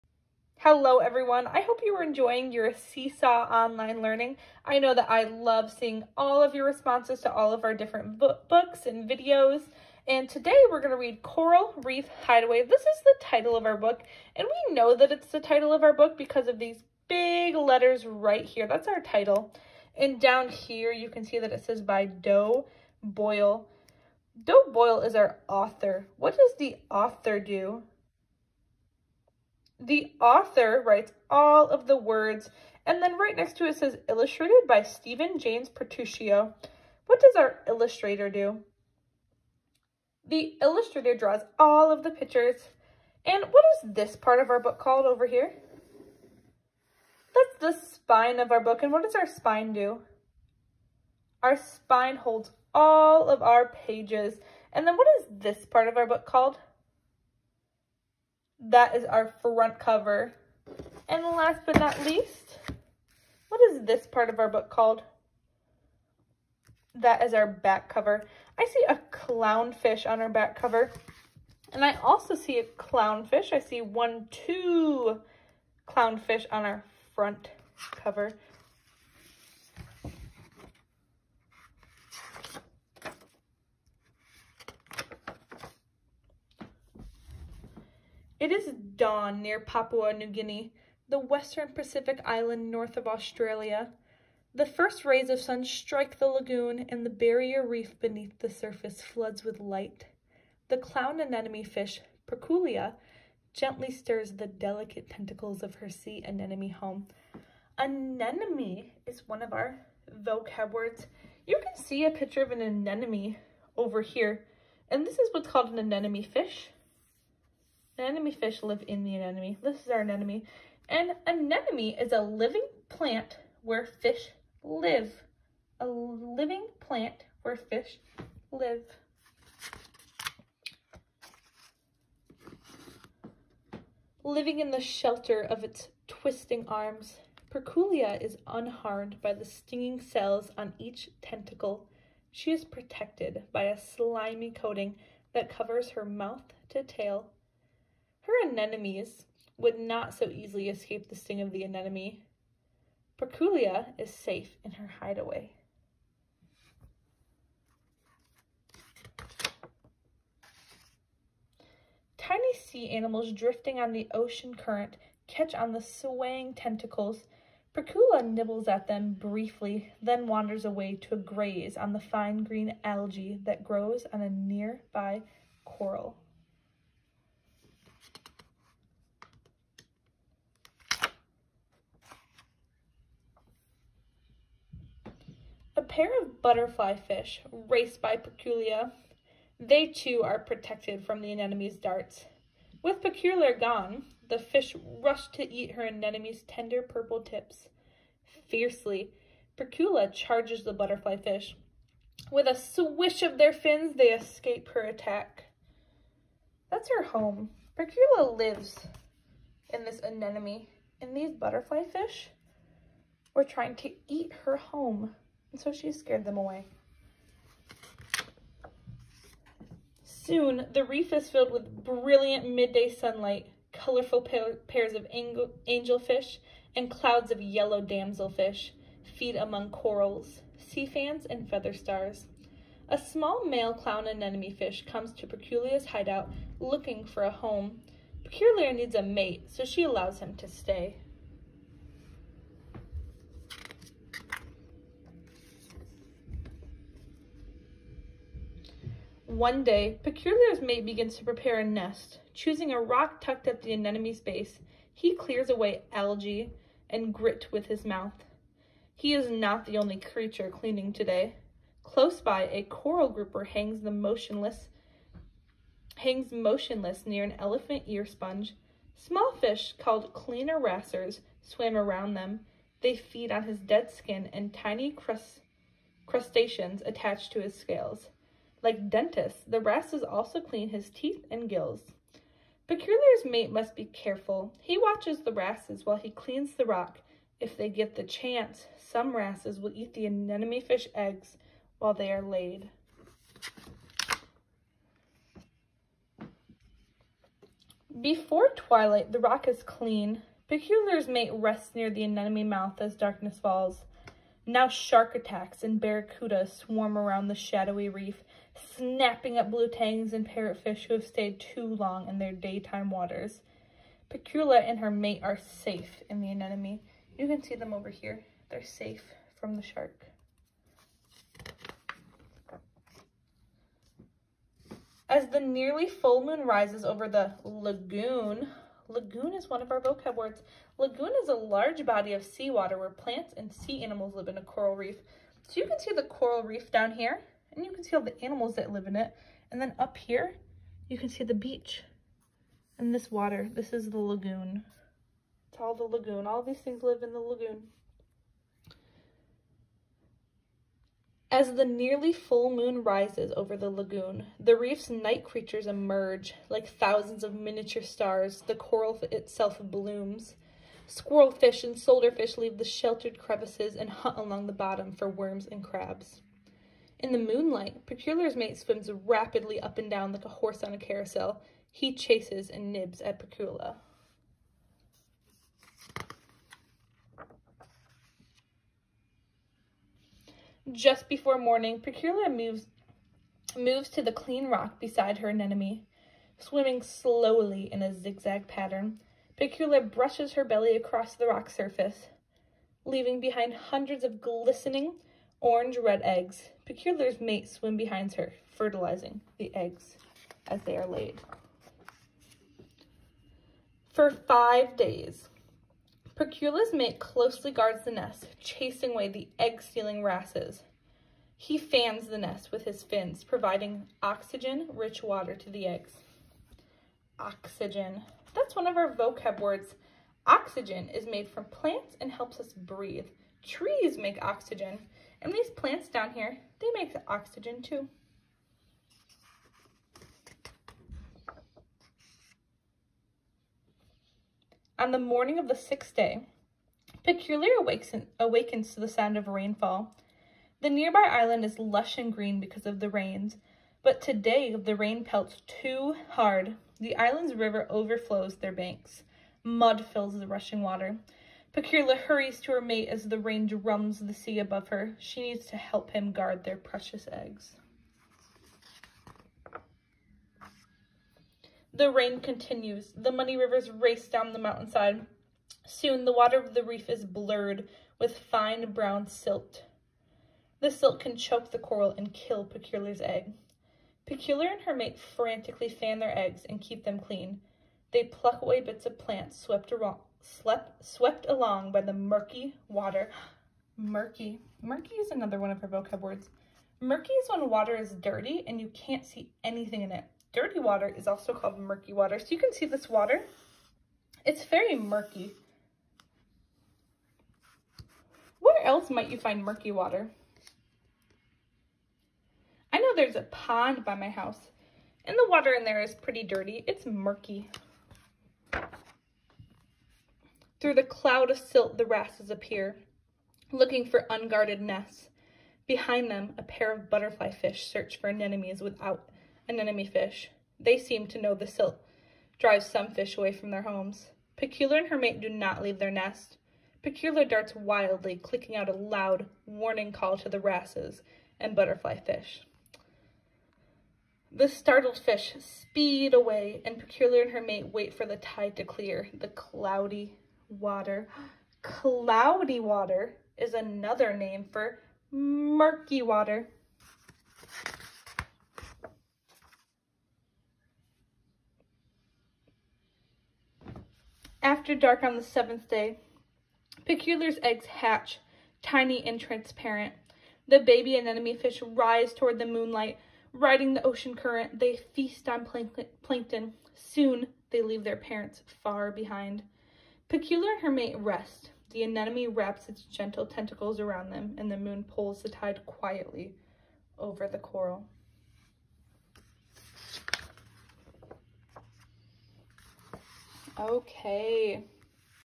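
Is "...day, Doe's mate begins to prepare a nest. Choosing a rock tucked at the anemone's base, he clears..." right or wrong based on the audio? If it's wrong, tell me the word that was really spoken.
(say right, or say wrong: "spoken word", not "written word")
wrong: "Percula", not "Doe".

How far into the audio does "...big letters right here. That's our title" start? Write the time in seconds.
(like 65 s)
17 s.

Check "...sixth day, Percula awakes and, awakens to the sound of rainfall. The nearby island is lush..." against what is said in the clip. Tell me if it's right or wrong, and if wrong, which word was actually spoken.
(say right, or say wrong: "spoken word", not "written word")
right.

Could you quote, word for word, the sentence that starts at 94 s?
The first rays of sun strike the lagoon, and the barrier reef beneath the surface floods with light.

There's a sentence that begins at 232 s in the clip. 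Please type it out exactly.
A small male clown anemone fish comes to Percula's hideout looking for a home.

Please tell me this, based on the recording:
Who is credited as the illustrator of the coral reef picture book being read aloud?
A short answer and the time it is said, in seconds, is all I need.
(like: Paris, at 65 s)
Steven James Petruccio, at 34 s.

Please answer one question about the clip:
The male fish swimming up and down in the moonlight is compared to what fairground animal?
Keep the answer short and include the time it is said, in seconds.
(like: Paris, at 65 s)
a horse on a carousel, at 370 s.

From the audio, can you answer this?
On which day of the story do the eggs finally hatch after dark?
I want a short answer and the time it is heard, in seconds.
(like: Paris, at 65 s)
the seventh day, at 555 s.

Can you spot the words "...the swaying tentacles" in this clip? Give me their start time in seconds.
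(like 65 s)
165 s.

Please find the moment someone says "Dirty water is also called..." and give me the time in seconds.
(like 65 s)
490 s.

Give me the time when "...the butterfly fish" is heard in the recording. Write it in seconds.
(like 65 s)
200 s.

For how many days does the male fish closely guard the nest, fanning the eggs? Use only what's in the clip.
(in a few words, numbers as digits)
5.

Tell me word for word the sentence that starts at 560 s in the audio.
The baby anemone fish rise toward the moonlight, riding the ocean current.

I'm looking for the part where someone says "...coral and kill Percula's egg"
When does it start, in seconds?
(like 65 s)
471 s.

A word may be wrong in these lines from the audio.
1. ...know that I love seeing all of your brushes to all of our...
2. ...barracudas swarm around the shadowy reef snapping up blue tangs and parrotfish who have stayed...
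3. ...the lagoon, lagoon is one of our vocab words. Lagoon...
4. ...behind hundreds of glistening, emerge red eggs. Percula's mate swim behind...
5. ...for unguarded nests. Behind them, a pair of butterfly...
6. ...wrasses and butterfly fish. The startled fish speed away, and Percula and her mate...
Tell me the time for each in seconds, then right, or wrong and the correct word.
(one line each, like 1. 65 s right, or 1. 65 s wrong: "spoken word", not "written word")
1. 4 s wrong: "responses", not "brushes"
2. 305 s right
3. 327 s right
4. 393 s wrong: "orange", not "emerge"
5. 513 s right
6. 530 s right.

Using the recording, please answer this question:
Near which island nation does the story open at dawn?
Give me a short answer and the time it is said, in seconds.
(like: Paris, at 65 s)
Papua New Guinea, at 89 s.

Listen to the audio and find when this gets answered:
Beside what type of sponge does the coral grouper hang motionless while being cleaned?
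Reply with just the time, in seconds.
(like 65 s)
267 s.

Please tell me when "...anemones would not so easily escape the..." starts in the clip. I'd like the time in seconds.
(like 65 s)
148 s.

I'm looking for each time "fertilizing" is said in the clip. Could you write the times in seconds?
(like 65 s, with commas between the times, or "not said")
398 s.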